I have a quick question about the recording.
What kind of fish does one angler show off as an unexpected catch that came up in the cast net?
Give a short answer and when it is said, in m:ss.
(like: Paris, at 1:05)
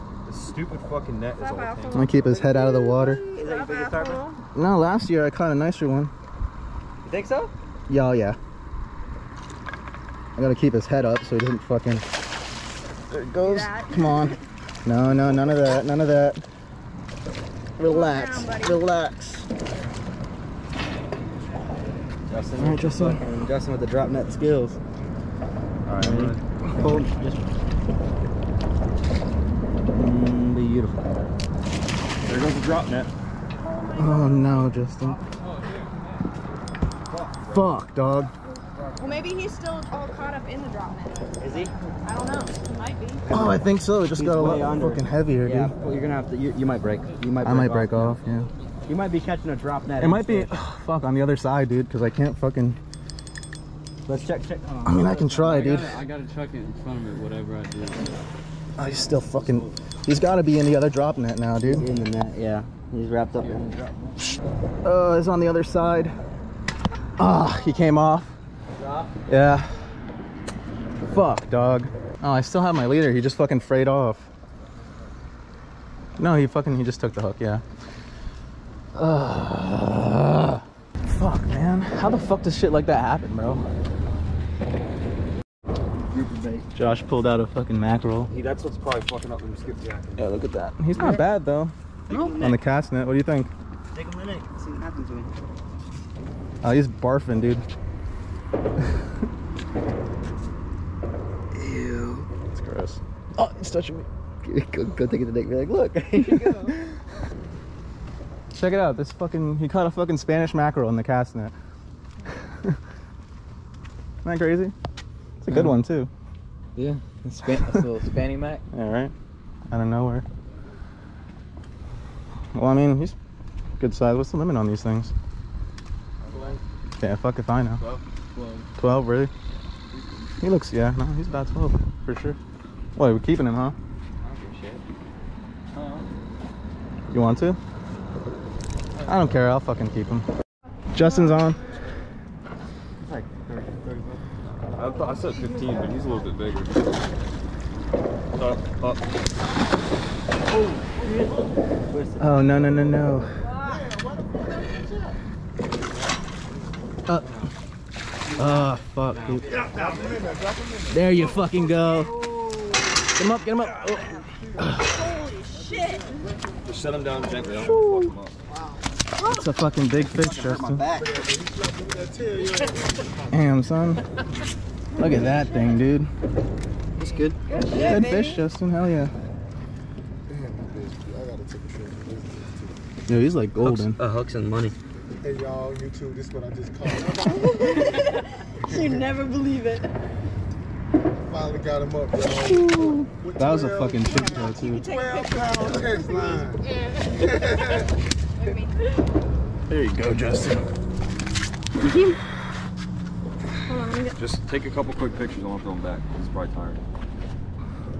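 Spanish mackerel, at 1:50.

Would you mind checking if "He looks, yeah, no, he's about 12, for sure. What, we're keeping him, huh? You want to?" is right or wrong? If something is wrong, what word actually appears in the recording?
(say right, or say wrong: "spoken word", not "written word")
right.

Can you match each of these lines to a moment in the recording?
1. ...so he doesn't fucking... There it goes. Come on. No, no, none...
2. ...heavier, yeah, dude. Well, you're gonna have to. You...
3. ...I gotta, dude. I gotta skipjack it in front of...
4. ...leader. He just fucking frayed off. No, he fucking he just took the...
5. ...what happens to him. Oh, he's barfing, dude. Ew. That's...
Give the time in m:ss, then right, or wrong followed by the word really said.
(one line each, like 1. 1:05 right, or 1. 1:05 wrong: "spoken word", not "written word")
1. 0:11 right
2. 0:45 right
3. 0:55 wrong: "chuck", not "skipjack"
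4. 1:12 right
5. 1:34 right.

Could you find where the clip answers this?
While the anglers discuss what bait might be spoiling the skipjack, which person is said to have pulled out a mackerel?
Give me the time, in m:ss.
1:26.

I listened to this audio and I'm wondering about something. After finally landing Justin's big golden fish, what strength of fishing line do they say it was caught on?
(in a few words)
12 pound test.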